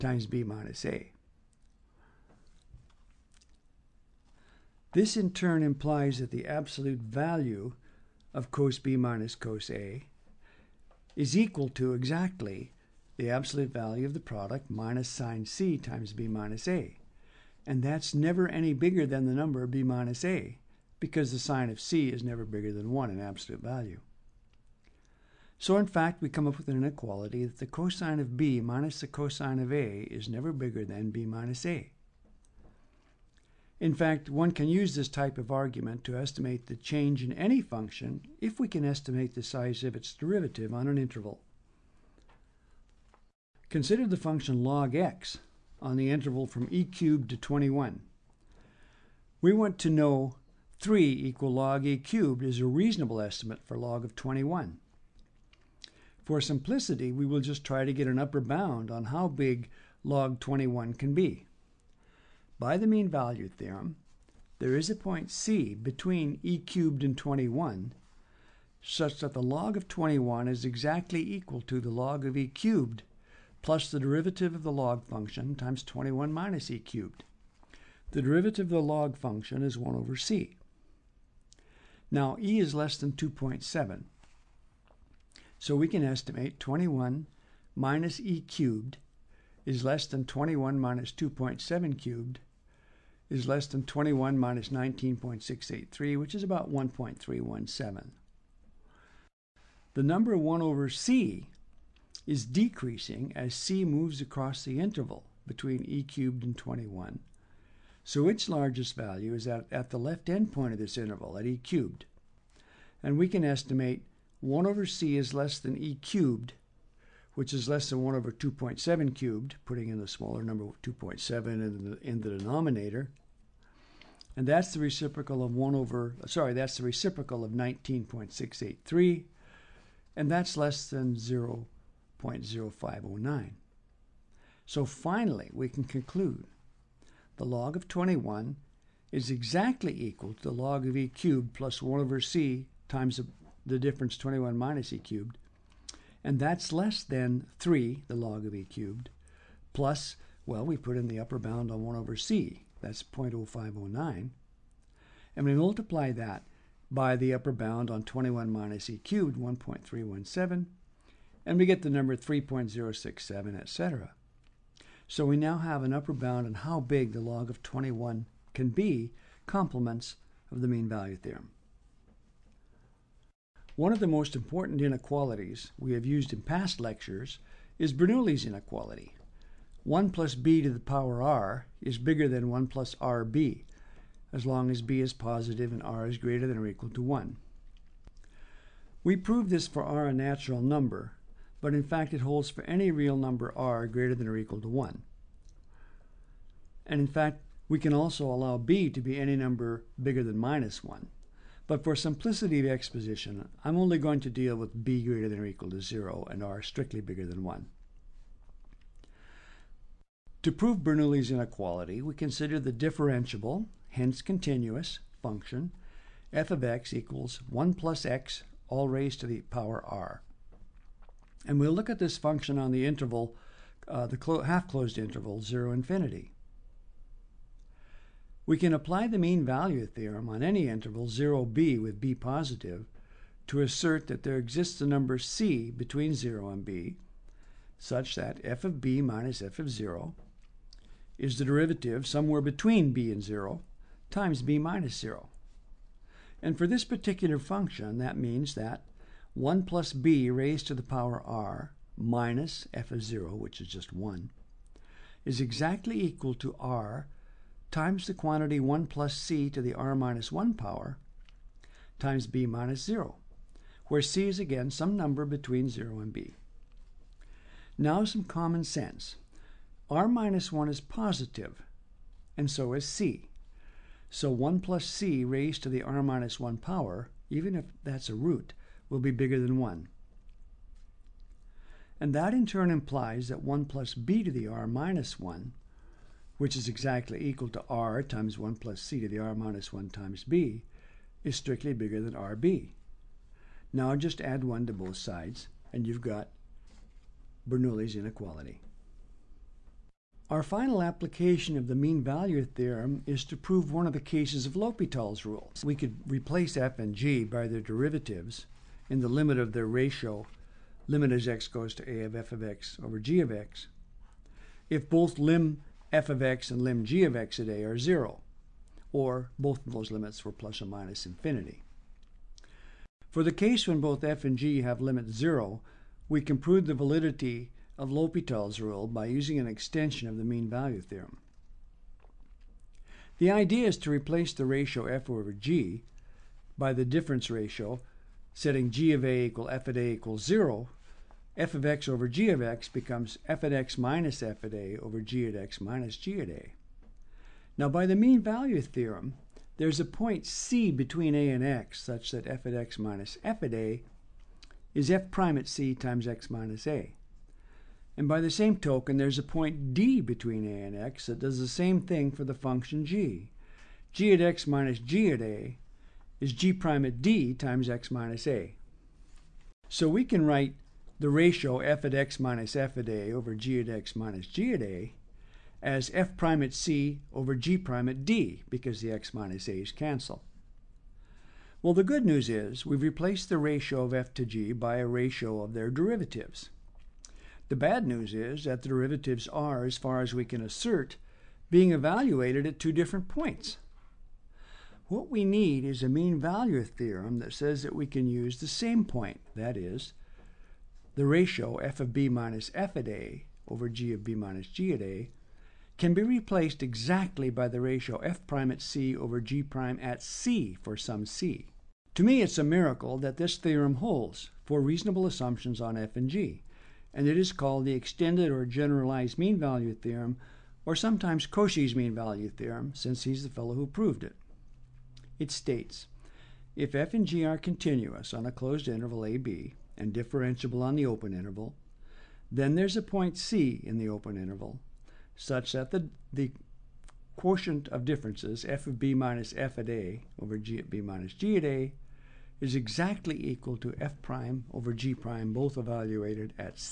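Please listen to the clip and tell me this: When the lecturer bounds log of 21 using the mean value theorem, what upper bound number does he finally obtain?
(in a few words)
3.067.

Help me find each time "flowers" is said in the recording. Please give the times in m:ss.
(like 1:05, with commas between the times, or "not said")
not said.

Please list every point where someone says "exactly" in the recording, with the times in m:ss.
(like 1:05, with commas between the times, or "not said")
0:11, 1:10, 2:19, 4:15, 4:46, 6:46, 7:22.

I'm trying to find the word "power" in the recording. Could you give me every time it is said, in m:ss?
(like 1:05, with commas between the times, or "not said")
3:00, 3:39, 4:10, 4:20, 4:36.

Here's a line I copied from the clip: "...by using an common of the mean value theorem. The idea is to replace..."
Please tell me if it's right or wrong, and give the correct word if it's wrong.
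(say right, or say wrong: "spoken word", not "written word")
wrong: "extension", not "common".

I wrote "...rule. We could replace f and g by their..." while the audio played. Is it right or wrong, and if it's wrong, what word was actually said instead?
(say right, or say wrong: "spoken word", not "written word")
right.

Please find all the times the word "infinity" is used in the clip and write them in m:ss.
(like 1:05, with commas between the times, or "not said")
3:45, 5:21.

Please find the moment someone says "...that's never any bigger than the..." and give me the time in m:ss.
0:17.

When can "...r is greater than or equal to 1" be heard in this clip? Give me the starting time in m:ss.
3:05.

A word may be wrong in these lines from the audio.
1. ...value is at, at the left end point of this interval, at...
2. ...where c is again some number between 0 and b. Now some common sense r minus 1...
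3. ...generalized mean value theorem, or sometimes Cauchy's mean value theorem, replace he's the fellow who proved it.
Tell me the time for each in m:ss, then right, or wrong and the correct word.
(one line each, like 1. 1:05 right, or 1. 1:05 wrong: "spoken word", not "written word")
1. 1:48 right
2. 4:23 right
3. 6:58 wrong: "since", not "replace".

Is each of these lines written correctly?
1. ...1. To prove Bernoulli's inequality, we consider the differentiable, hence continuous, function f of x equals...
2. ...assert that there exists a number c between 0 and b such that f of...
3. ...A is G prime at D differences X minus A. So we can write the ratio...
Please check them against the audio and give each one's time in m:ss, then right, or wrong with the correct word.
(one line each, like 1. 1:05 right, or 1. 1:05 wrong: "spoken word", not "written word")
1. 3:27 right
2. 3:53 right
3. 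6:05 wrong: "times", not "differences".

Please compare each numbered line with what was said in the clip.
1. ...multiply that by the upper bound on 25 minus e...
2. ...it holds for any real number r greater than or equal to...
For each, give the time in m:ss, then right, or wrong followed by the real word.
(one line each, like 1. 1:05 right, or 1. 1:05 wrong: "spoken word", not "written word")
1. 2:35 wrong: "21", not "25"
2. 3:12 right.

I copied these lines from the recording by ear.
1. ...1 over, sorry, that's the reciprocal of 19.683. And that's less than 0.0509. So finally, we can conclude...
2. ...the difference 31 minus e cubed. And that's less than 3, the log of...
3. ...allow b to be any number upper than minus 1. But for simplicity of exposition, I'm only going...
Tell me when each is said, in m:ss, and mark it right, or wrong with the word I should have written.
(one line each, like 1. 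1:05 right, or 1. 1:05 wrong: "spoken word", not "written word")
1. 2:05 right
2. 2:23 wrong: "21", not "31"
3. 3:18 wrong: "bigger", not "upper".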